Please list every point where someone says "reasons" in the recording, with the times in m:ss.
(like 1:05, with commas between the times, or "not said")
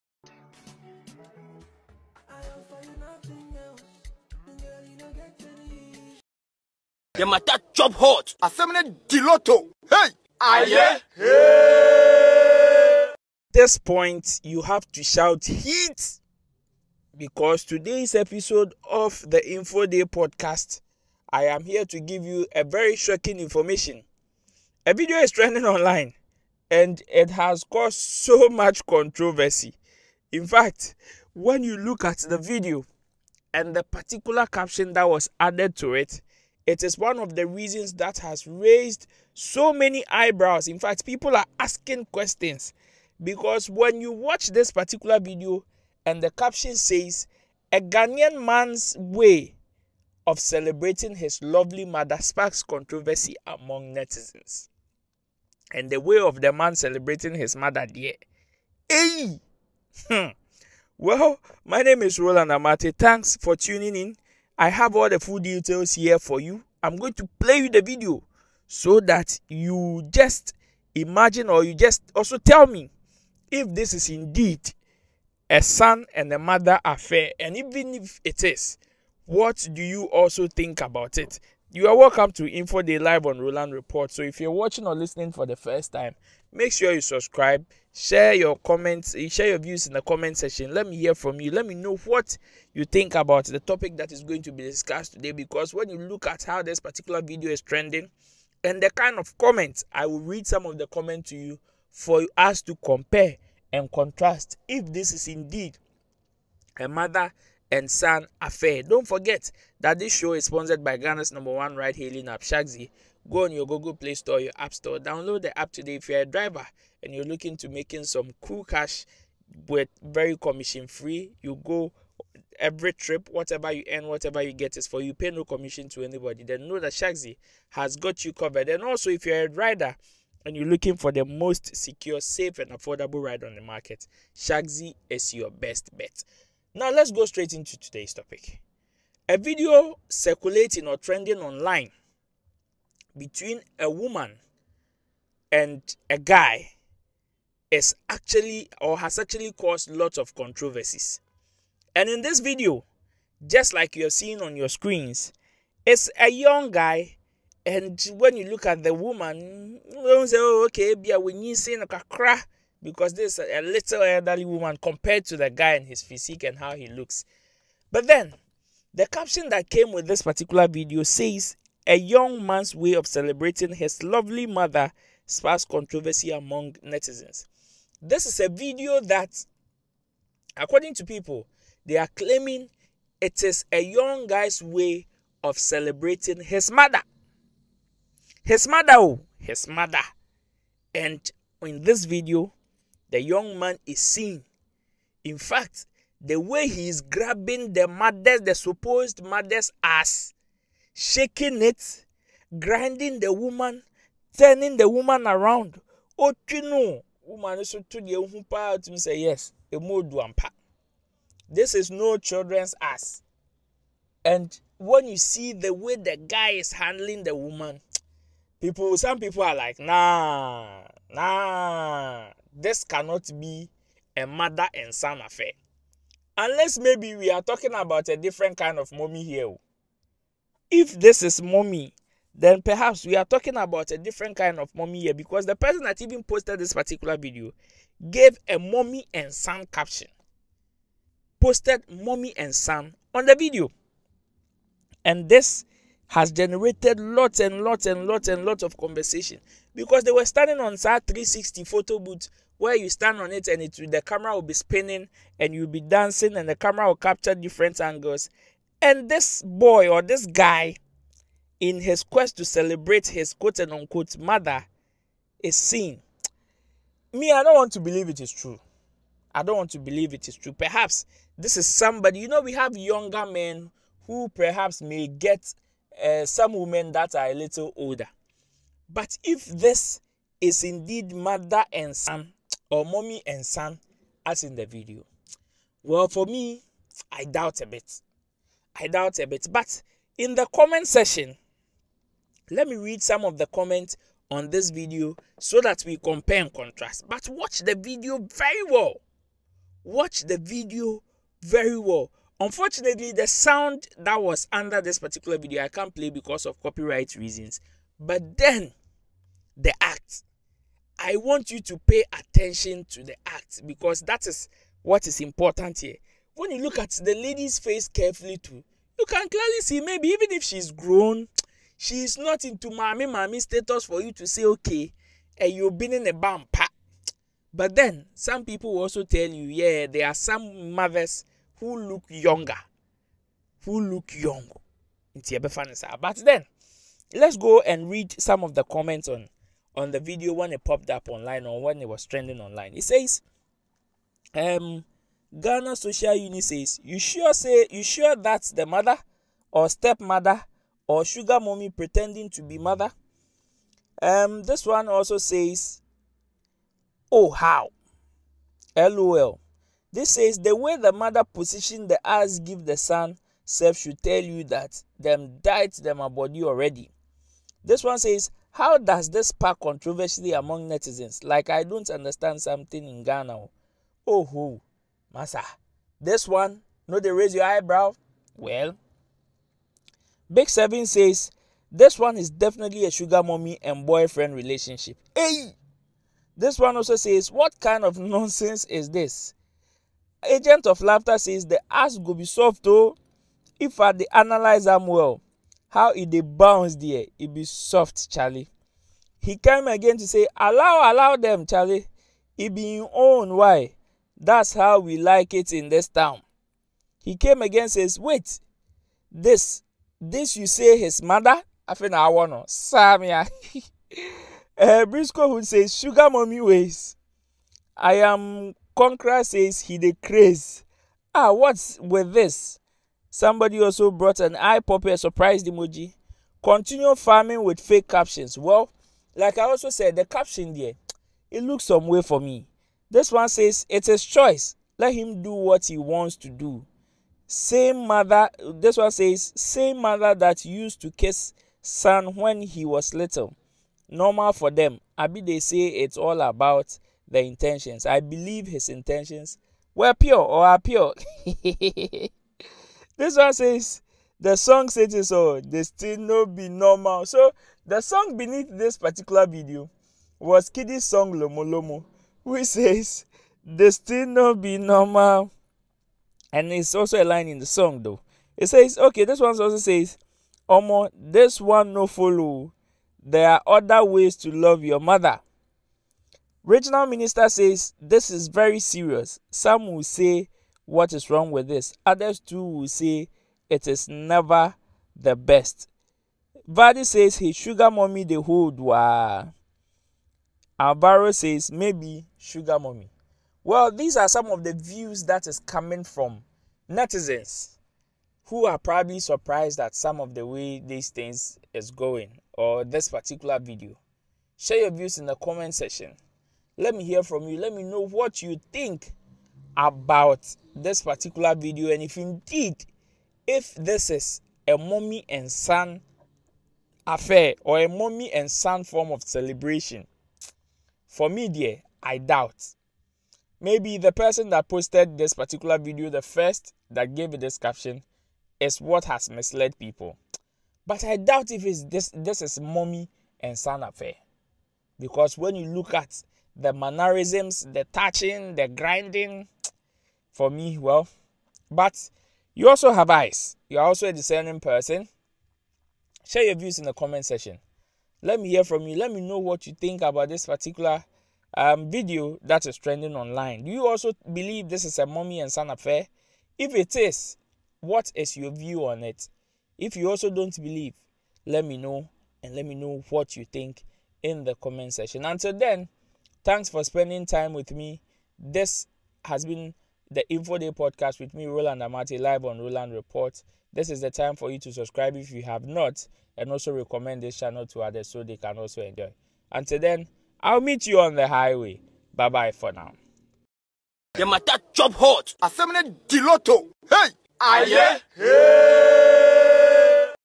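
0:37, 5:07.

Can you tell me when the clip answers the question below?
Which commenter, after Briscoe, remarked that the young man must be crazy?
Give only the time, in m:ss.
6:57.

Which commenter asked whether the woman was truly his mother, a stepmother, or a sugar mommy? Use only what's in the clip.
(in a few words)
Ghana Social Unit.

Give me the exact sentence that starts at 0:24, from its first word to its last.
A video is trending online and it has caused so much controversy.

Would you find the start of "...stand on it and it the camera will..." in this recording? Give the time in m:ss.
4:12.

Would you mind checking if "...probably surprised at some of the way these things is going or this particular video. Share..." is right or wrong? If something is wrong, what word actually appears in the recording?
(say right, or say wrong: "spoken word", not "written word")
right.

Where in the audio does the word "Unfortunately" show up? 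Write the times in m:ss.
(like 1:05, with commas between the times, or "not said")
5:02.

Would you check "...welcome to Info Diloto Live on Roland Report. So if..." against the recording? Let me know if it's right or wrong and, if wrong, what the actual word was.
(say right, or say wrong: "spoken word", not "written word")
wrong: "Day", not "Diloto".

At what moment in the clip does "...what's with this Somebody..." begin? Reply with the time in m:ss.
7:01.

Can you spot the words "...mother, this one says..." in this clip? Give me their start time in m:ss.
7:17.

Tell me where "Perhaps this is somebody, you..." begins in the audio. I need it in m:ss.
4:30.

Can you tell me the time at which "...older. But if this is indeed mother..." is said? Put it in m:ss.
4:37.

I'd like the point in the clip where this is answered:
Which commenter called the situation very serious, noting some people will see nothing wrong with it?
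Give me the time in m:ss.
7:56.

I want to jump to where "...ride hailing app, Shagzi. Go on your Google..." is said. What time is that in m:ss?
1:51.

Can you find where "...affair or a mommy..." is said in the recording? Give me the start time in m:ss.
8:36.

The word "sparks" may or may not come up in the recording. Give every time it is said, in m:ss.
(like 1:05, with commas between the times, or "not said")
0:52, 2:55, 6:09.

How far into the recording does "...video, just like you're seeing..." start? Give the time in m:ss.
2:32.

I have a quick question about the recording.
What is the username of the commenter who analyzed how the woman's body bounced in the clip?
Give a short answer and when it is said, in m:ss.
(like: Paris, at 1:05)
Agent of Laughter, at 6:30.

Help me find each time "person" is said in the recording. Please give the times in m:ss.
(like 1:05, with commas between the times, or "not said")
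3:55, 8:43, 9:04.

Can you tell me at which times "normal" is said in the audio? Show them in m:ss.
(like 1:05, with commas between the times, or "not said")
7:23, 7:36, 7:44.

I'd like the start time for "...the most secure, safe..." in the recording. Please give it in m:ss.
2:11.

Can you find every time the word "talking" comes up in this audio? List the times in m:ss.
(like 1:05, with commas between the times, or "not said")
3:47, 3:53.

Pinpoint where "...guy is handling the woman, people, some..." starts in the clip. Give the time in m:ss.
3:36.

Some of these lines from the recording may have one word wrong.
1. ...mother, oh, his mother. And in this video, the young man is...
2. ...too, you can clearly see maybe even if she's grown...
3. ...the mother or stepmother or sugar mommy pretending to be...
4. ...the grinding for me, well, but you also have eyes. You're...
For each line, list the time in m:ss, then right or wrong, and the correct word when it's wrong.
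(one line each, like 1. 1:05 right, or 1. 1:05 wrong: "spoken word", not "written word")
1. 3:08 right
2. 5:18 right
3. 5:48 right
4. 8:58 right.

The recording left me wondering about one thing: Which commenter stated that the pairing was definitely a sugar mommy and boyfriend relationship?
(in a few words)
Big Seven.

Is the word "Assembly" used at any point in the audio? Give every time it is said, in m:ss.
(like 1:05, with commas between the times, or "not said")
0:08, 9:45.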